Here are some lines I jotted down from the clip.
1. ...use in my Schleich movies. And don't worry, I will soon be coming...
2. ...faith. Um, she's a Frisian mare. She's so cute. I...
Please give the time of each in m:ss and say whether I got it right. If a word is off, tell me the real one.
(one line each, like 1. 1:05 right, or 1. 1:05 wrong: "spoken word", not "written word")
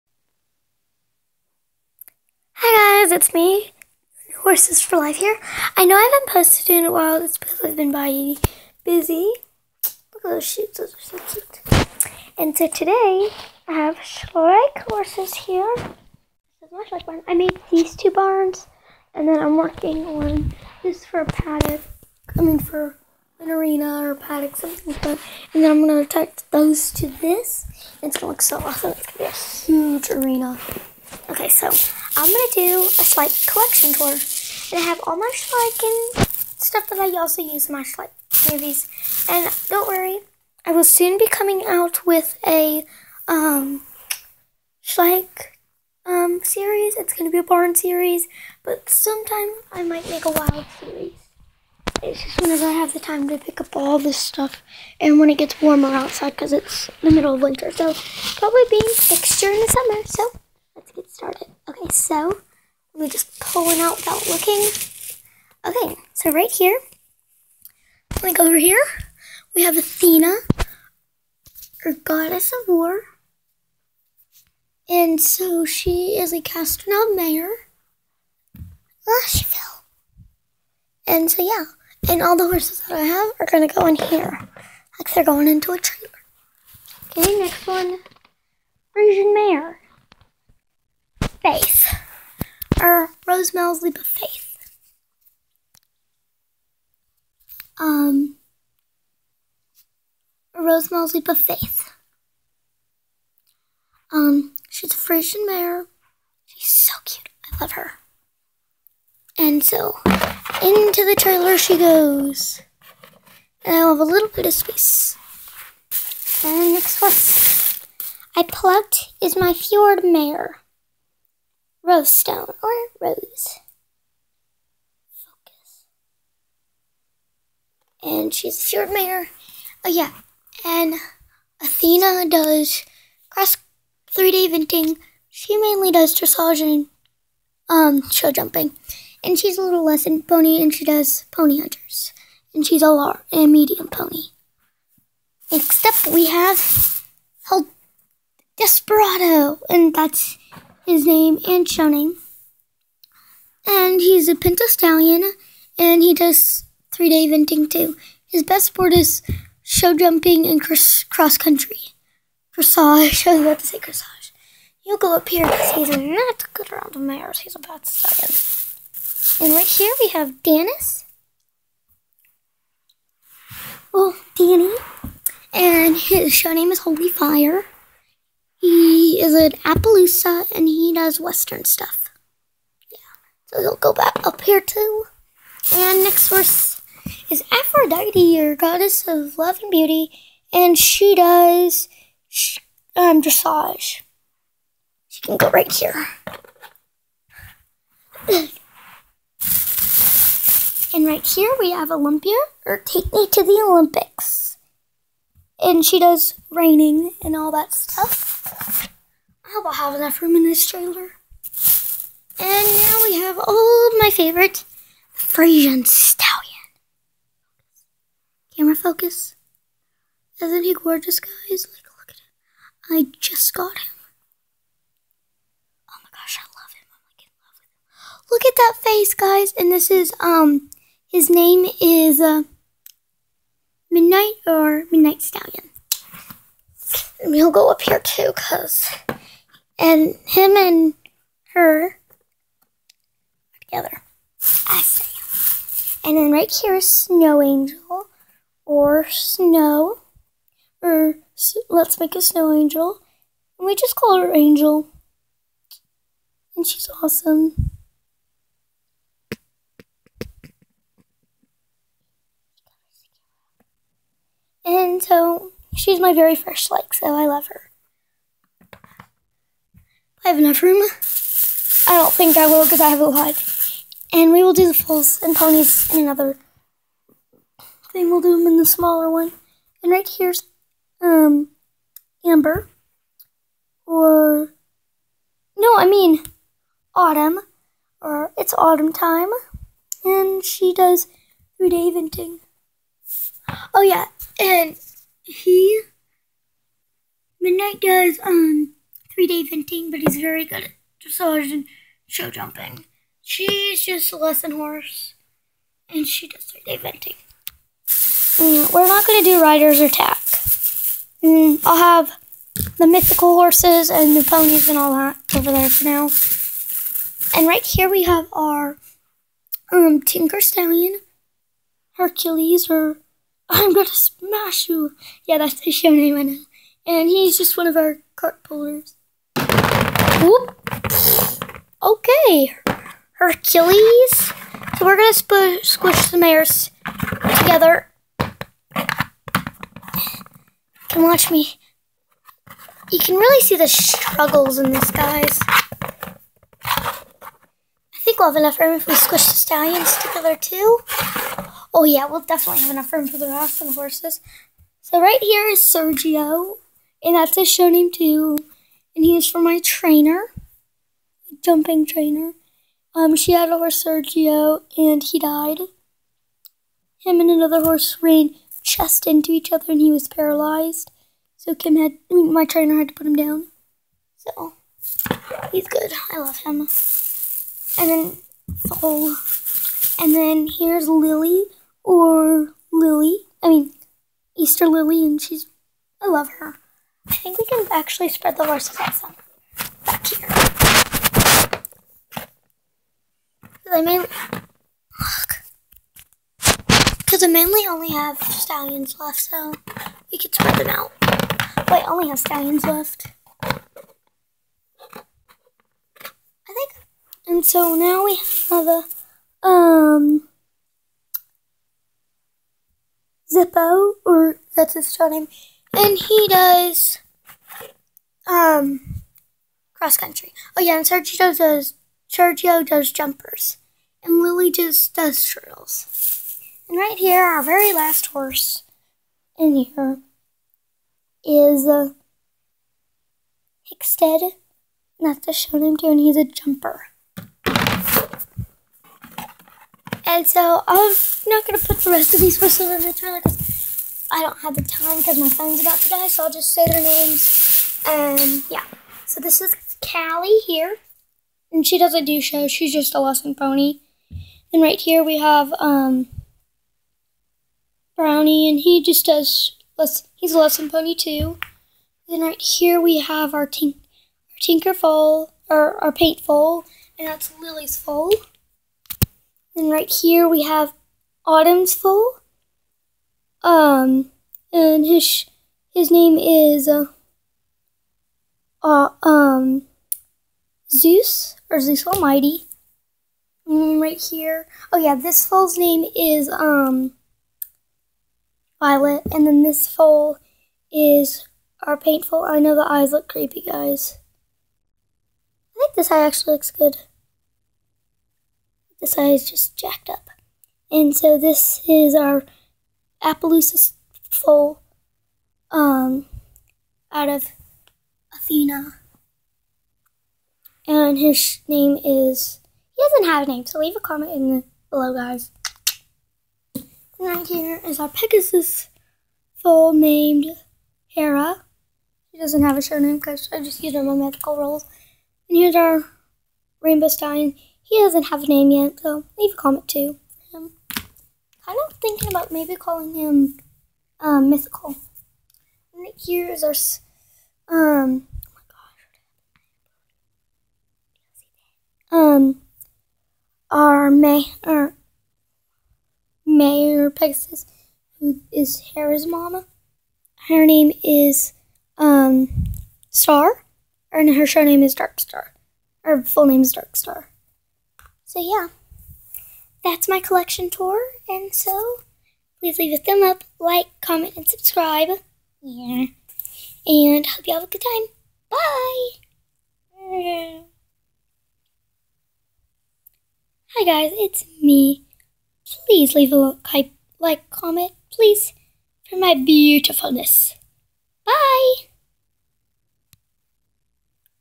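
1. 0:37 right
2. 1:41 right.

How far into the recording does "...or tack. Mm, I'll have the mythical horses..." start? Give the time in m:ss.
5:09.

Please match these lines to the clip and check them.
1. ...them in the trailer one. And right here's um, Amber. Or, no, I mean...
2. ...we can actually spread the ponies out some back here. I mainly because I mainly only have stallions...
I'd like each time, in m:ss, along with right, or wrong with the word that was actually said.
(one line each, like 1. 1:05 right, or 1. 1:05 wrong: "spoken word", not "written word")
1. 4:38 wrong: "smaller", not "trailer"
2. 6:27 wrong: "horses", not "ponies".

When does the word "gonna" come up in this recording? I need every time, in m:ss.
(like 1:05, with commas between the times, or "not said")
0:32, 0:47, 1:23, 5:23, 7:21.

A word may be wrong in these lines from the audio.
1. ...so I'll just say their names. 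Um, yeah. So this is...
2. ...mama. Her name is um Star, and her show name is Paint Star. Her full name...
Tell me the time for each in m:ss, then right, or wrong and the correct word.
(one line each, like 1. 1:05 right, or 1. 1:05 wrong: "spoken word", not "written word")
1. 7:26 right
2. 9:09 wrong: "Dark", not "Paint".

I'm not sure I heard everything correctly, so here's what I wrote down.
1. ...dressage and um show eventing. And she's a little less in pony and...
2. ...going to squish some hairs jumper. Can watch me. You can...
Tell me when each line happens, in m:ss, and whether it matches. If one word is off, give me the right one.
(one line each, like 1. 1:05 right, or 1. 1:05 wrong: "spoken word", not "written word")
1. 2:16 wrong: "jumping", not "eventing"
2. 5:34 wrong: "together", not "jumper".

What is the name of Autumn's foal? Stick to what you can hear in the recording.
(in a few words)
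Zeus Almighty.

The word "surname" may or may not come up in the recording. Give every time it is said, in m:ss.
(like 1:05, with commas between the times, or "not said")
8:42.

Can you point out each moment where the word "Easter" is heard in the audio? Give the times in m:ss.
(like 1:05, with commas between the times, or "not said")
6:24.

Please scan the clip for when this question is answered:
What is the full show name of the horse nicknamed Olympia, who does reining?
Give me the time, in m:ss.
3:22.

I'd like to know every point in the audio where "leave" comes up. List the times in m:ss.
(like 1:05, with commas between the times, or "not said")
8:33, 8:49, 9:22, 9:35.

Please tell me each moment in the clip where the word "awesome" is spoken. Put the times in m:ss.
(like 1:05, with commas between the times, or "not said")
0:28, 4:17.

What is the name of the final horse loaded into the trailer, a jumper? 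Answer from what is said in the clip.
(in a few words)
Hickstead.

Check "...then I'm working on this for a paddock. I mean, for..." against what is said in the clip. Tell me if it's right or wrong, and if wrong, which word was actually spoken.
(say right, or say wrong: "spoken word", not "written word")
right.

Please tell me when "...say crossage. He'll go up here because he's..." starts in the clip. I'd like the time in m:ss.
2:43.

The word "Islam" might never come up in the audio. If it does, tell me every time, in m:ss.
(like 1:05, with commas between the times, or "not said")
not said.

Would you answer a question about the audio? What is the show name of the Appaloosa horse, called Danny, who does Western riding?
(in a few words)
Holy Fire.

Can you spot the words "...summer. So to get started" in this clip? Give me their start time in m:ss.
0:59.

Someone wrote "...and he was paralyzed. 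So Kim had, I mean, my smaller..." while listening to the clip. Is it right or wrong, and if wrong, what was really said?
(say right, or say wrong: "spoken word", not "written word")
wrong: "trainer", not "smaller".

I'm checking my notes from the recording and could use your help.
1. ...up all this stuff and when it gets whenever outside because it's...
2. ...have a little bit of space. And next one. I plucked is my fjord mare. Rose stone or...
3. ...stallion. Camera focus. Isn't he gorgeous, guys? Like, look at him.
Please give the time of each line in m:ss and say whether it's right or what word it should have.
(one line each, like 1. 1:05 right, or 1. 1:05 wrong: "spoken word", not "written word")
1. 0:53 wrong: "warmer", not "whenever"
2. 1:53 right
3. 3:35 right.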